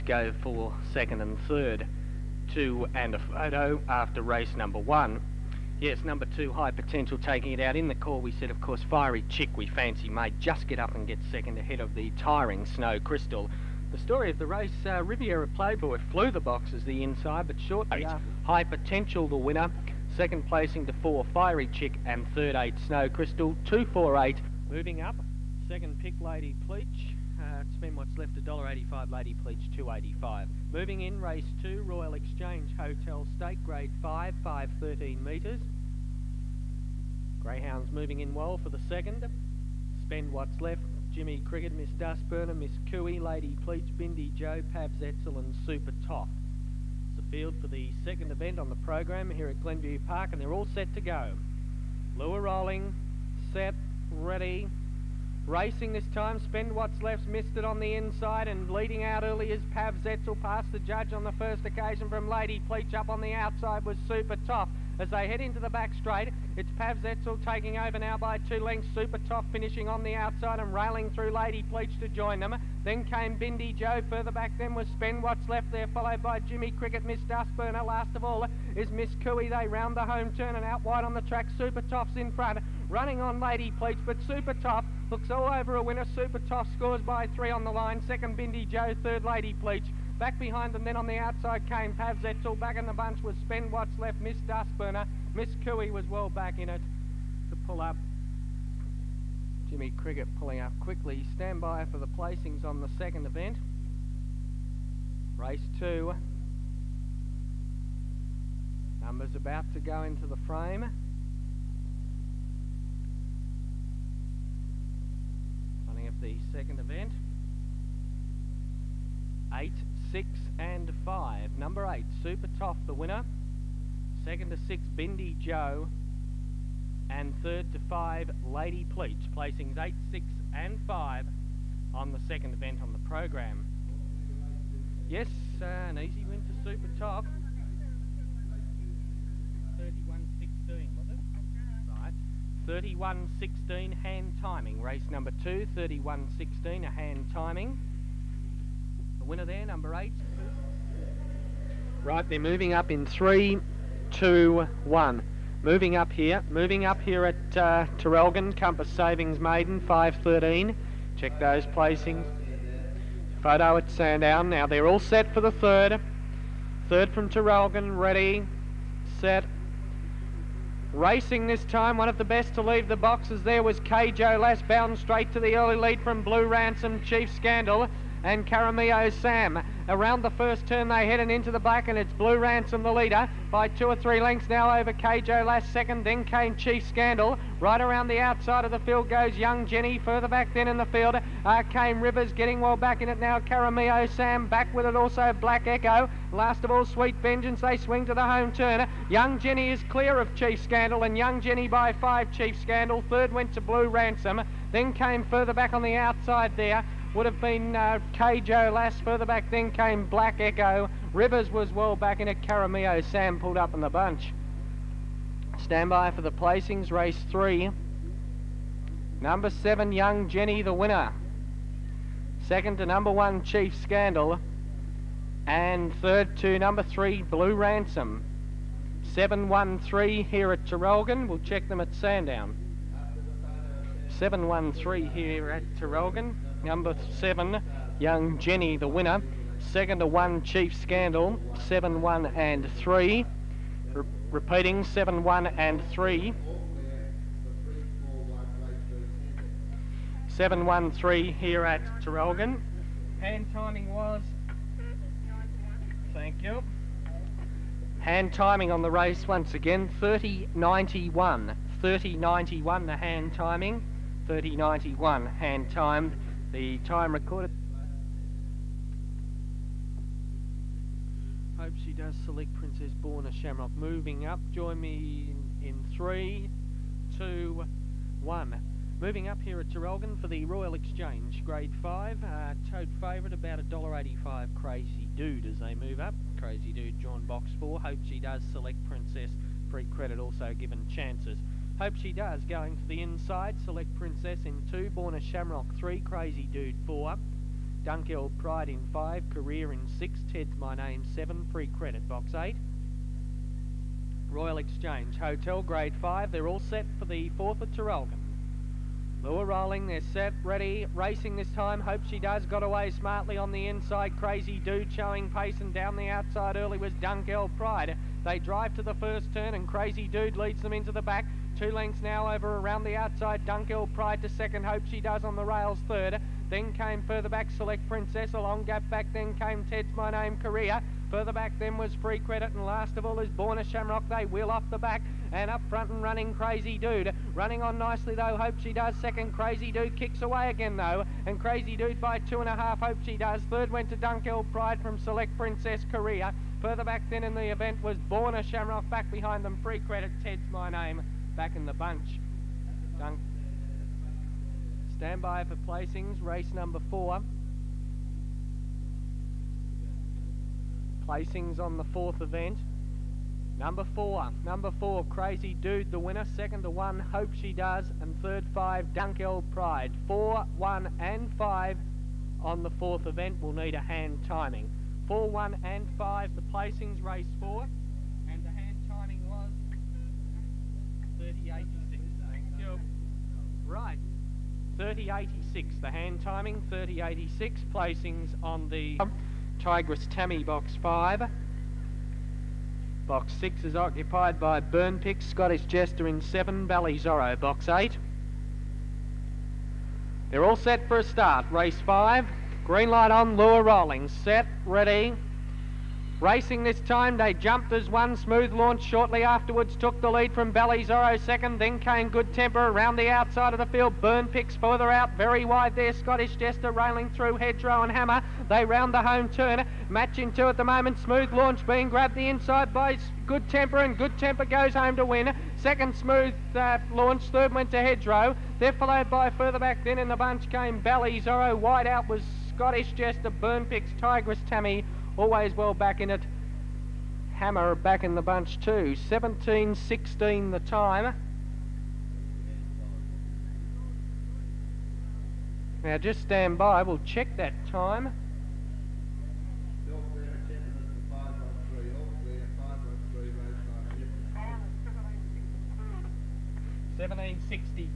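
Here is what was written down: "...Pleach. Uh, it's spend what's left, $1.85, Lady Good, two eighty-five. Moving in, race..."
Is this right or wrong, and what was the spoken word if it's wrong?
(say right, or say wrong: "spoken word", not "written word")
wrong: "Pleach", not "Good".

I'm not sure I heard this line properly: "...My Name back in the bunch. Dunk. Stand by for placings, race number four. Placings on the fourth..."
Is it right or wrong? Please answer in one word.
right.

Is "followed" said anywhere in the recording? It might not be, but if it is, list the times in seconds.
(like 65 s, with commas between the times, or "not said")
75 s, 428 s.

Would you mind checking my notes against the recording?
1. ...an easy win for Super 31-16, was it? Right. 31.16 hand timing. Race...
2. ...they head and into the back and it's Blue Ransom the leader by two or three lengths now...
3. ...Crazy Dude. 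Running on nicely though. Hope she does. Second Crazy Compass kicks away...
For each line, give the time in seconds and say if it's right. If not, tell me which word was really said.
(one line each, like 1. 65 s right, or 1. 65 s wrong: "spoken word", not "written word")
1. 135 s right
2. 180 s right
3. 336 s wrong: "Dude", not "Compass".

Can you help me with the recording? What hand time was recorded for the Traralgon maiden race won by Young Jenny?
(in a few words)
30.91.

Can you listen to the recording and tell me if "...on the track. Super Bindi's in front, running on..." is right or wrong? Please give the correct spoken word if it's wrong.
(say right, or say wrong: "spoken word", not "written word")
wrong: "Top", not "Bindi".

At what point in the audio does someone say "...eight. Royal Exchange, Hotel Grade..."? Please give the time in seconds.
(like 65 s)
302 s.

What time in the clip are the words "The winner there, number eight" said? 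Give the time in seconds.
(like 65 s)
149 s.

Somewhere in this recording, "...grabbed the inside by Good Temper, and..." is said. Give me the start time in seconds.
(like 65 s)
421 s.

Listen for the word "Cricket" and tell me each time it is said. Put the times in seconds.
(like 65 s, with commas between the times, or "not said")
41 s, 76 s, 99 s.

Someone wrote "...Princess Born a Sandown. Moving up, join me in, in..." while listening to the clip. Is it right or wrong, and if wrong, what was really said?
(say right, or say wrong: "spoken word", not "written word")
wrong: "Shamrock", not "Sandown".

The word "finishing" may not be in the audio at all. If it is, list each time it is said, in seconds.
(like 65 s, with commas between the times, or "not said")
69 s.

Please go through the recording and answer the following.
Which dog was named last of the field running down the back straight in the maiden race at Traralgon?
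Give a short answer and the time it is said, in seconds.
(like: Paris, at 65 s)
Sweet Vengeance, at 196 s.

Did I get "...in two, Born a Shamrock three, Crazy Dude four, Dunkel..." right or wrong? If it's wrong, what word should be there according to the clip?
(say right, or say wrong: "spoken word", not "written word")
right.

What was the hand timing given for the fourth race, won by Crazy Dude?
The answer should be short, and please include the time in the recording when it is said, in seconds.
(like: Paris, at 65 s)
30.86, at 384 s.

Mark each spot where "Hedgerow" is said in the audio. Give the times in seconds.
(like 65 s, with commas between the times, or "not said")
417 s, 427 s.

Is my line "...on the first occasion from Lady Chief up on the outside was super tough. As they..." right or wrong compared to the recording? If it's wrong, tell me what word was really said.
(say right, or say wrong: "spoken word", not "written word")
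wrong: "Pleach", not "Chief".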